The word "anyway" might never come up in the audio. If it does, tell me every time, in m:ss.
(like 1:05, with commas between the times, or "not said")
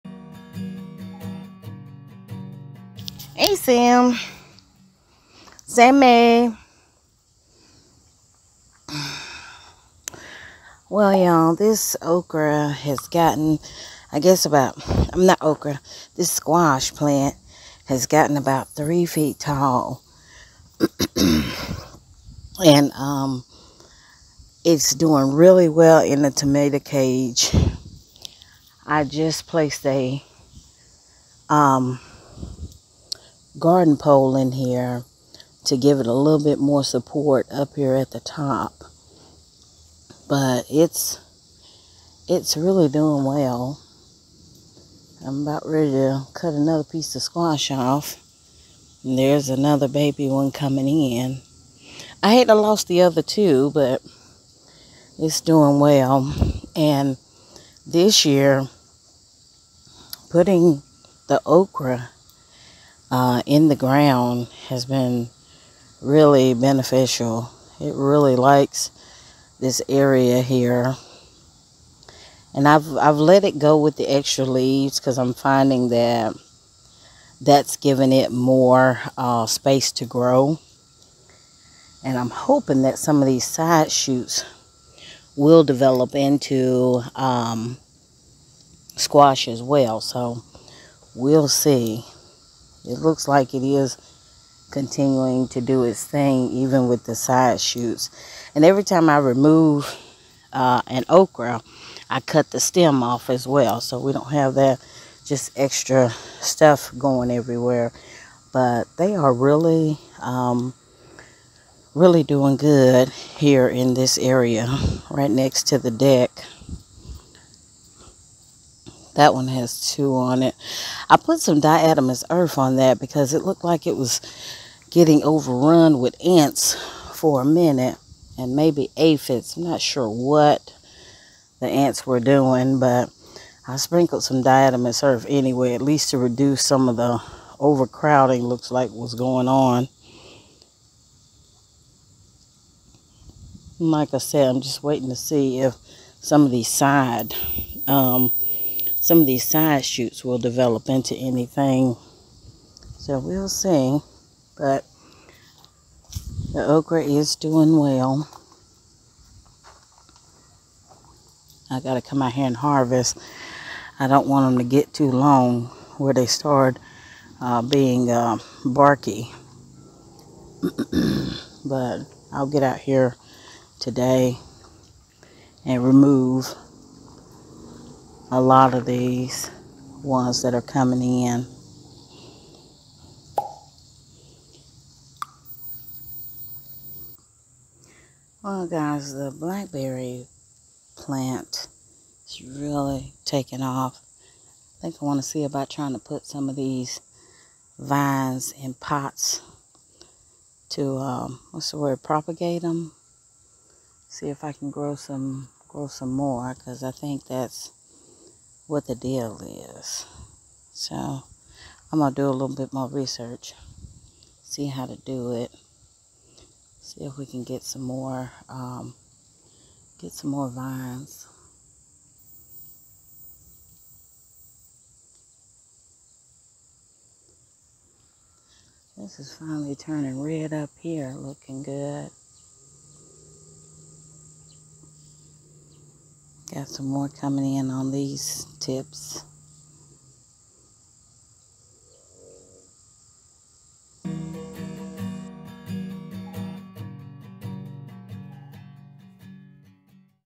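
2:15.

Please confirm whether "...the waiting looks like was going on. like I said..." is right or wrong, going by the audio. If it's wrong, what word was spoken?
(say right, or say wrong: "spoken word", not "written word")
wrong: "overcrowding", not "waiting".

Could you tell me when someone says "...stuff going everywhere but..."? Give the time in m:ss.
1:46.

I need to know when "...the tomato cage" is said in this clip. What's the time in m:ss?
0:26.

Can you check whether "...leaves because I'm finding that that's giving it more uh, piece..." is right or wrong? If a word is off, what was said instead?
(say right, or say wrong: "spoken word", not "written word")
wrong: "space", not "piece".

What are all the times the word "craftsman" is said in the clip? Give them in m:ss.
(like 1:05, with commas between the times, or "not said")
not said.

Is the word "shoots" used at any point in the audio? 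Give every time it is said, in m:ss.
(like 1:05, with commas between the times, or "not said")
1:23, 1:37, 2:29.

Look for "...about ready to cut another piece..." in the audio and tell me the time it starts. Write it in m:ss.
0:45.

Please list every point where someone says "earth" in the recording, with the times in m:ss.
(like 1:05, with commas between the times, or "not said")
2:02, 2:15.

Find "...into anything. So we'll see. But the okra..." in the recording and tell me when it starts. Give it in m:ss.
2:30.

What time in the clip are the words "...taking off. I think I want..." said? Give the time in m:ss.
3:13.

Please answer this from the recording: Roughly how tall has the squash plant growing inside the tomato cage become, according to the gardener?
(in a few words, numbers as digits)
3 feet.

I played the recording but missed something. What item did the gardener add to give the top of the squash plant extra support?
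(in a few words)
garden pole.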